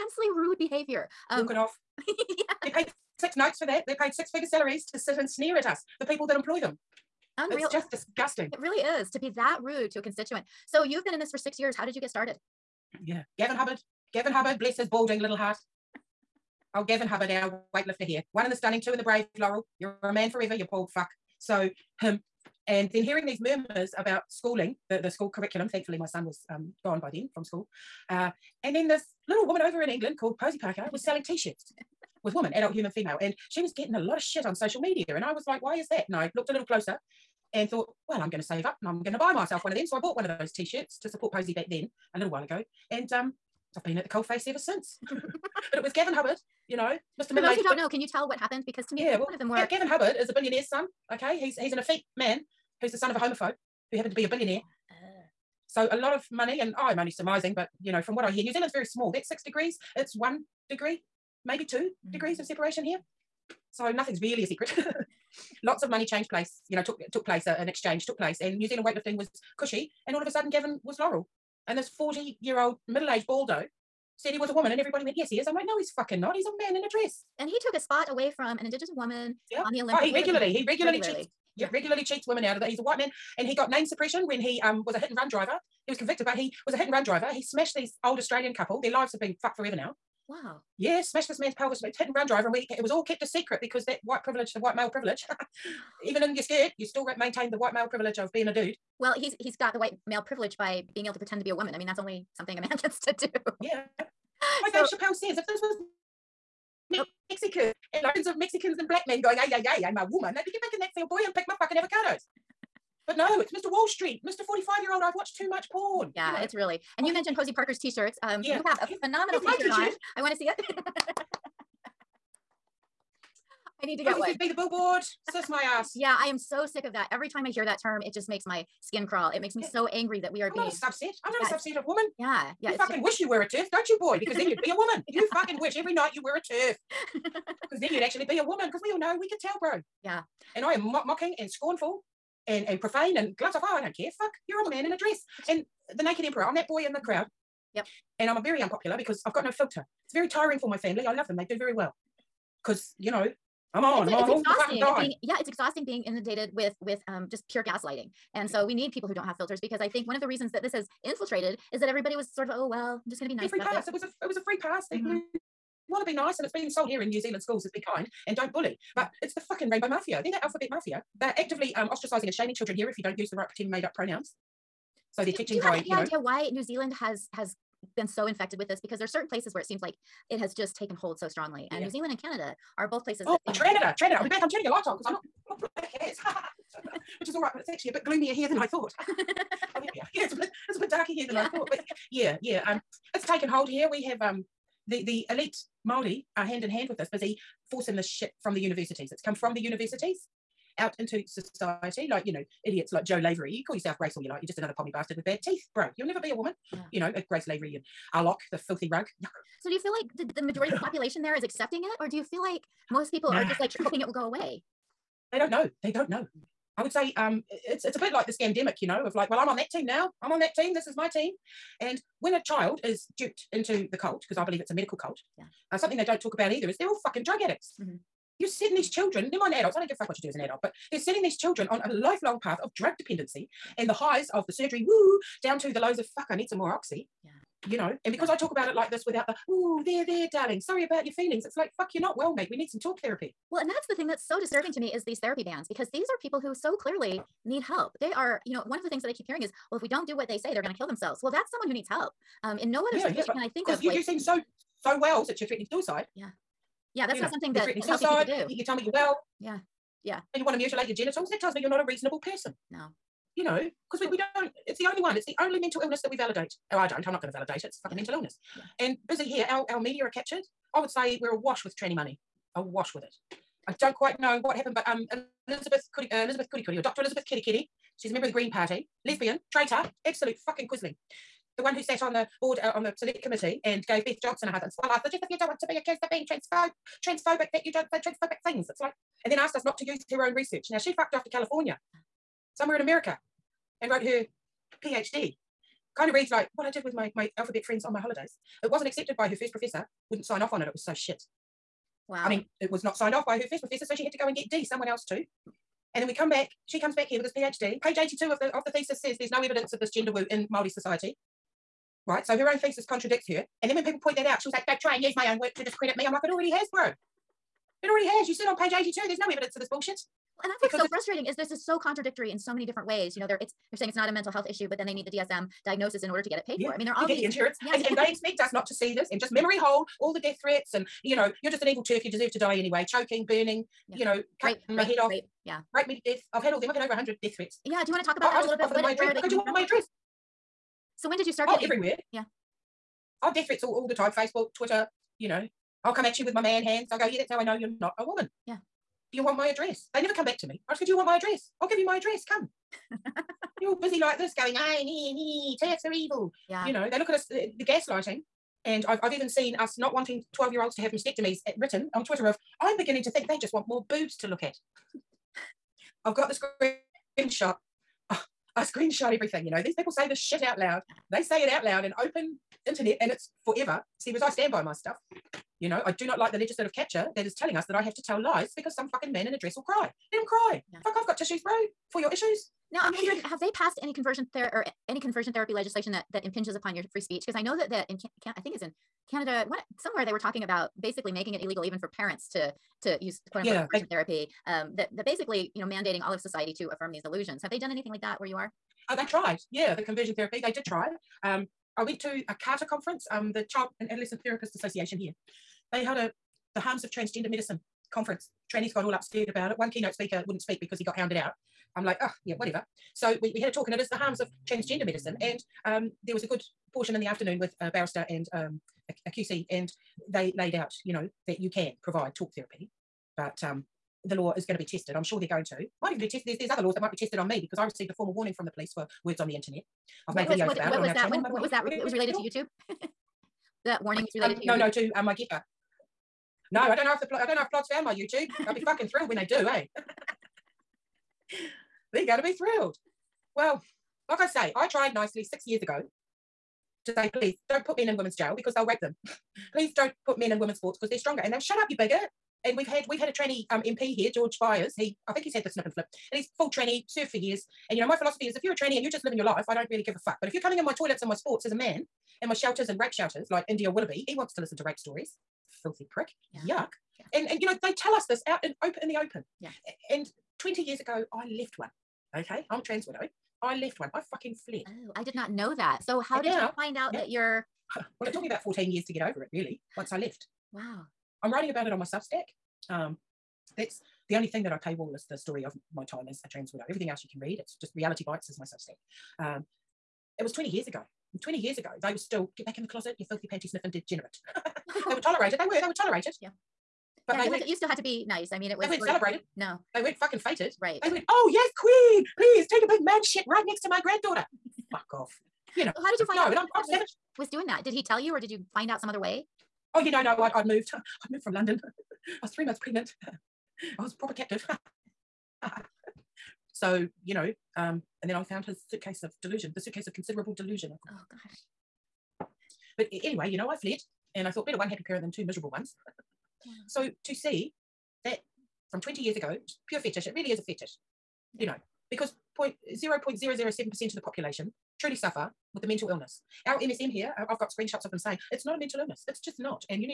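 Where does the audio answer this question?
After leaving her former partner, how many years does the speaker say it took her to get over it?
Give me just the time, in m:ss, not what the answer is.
7:58.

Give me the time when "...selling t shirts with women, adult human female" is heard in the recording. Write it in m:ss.
0:31.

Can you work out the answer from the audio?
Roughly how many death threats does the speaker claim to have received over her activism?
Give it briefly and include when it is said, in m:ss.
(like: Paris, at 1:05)
over 100, at 5:36.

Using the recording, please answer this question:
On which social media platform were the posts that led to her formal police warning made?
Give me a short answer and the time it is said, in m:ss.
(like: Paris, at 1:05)
Gettr, at 7:15.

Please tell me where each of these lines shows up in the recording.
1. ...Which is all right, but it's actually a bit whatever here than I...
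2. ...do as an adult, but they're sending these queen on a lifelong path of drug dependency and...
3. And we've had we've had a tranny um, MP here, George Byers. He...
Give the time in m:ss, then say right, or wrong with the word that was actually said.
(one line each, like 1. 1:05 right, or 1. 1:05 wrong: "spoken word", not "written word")
1. 3:07 wrong: "gloomier", not "whatever"
2. 3:50 wrong: "children", not "queen"
3. 7:32 right.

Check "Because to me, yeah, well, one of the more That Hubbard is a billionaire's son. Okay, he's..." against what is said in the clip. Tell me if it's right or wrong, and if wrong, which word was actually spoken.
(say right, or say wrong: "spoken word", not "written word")
wrong: "Gavin", not "That".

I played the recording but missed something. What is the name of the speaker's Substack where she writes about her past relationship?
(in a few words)
Reality Bites.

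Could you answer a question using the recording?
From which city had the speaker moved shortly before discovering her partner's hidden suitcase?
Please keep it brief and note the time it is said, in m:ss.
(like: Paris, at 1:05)
London, at 8:31.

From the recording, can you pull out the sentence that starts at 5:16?
I'm like, it already has, bro.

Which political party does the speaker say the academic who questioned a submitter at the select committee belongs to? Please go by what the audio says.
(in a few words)
Green Party.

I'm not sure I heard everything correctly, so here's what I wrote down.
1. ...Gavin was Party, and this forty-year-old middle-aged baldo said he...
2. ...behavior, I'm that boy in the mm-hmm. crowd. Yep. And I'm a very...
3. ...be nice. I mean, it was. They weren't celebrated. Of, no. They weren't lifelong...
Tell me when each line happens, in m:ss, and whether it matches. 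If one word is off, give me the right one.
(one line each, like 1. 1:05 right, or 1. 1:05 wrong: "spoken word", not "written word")
1. 1:10 wrong: "Laurel", not "Party"
2. 2:26 wrong: "emperor", not "behavior"
3. 8:17 wrong: "fucking", not "lifelong".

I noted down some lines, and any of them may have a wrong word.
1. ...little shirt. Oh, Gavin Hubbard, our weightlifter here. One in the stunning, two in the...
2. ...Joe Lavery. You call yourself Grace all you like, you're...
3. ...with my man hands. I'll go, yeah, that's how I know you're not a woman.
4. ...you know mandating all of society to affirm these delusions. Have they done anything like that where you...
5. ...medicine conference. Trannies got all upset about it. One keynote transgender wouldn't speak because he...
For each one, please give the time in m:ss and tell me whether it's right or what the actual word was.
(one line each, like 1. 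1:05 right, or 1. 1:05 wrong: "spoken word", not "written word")
1. 0:15 wrong: "heart", not "shirt"
2. 3:23 right
3. 5:46 right
4. 6:35 right
5. 6:47 wrong: "speaker", not "transgender".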